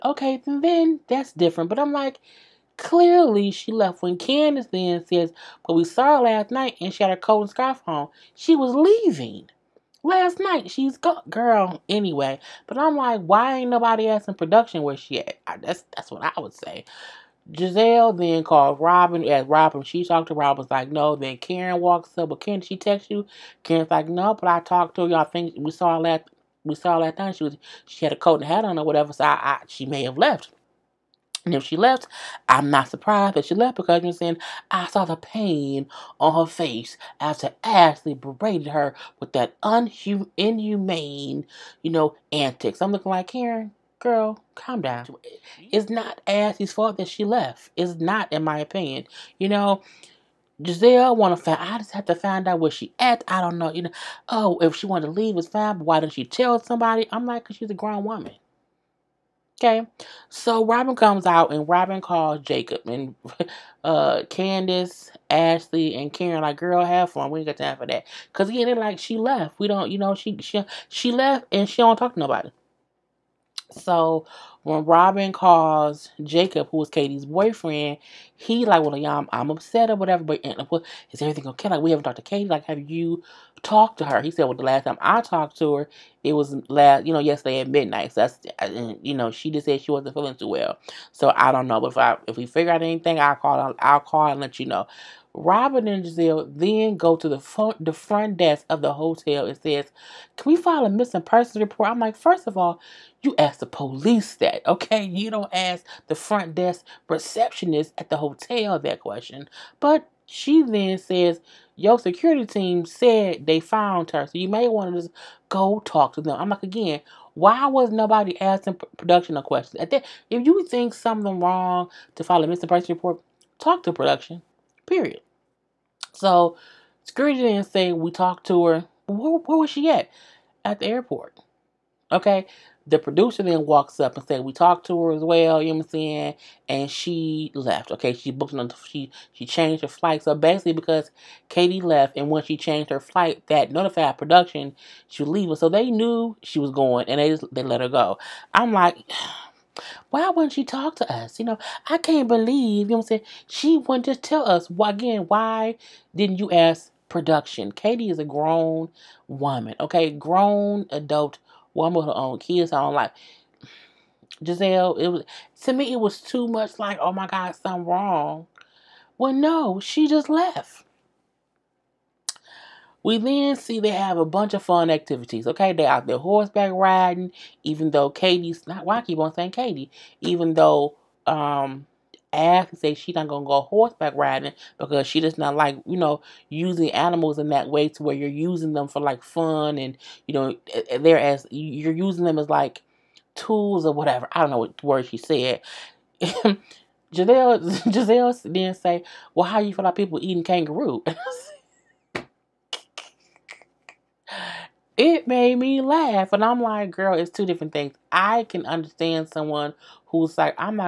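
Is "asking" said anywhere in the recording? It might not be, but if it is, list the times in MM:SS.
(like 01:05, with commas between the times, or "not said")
00:14, 01:58.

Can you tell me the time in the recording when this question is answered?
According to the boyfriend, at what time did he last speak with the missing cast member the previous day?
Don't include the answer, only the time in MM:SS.
01:27.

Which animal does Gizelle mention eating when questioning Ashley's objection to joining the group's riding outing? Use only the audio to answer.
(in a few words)
Kangaroo.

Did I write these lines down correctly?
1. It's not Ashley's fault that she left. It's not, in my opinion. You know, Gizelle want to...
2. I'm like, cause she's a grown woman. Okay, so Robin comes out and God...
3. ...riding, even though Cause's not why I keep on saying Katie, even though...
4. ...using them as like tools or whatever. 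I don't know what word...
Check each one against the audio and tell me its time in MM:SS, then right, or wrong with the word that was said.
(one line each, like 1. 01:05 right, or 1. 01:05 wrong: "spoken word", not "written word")
1. 00:45 right
2. 00:57 wrong: "Robin", not "God"
3. 02:56 wrong: "Katie", not "Cause"
4. 03:11 right.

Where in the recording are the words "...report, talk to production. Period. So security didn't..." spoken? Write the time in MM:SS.
02:02.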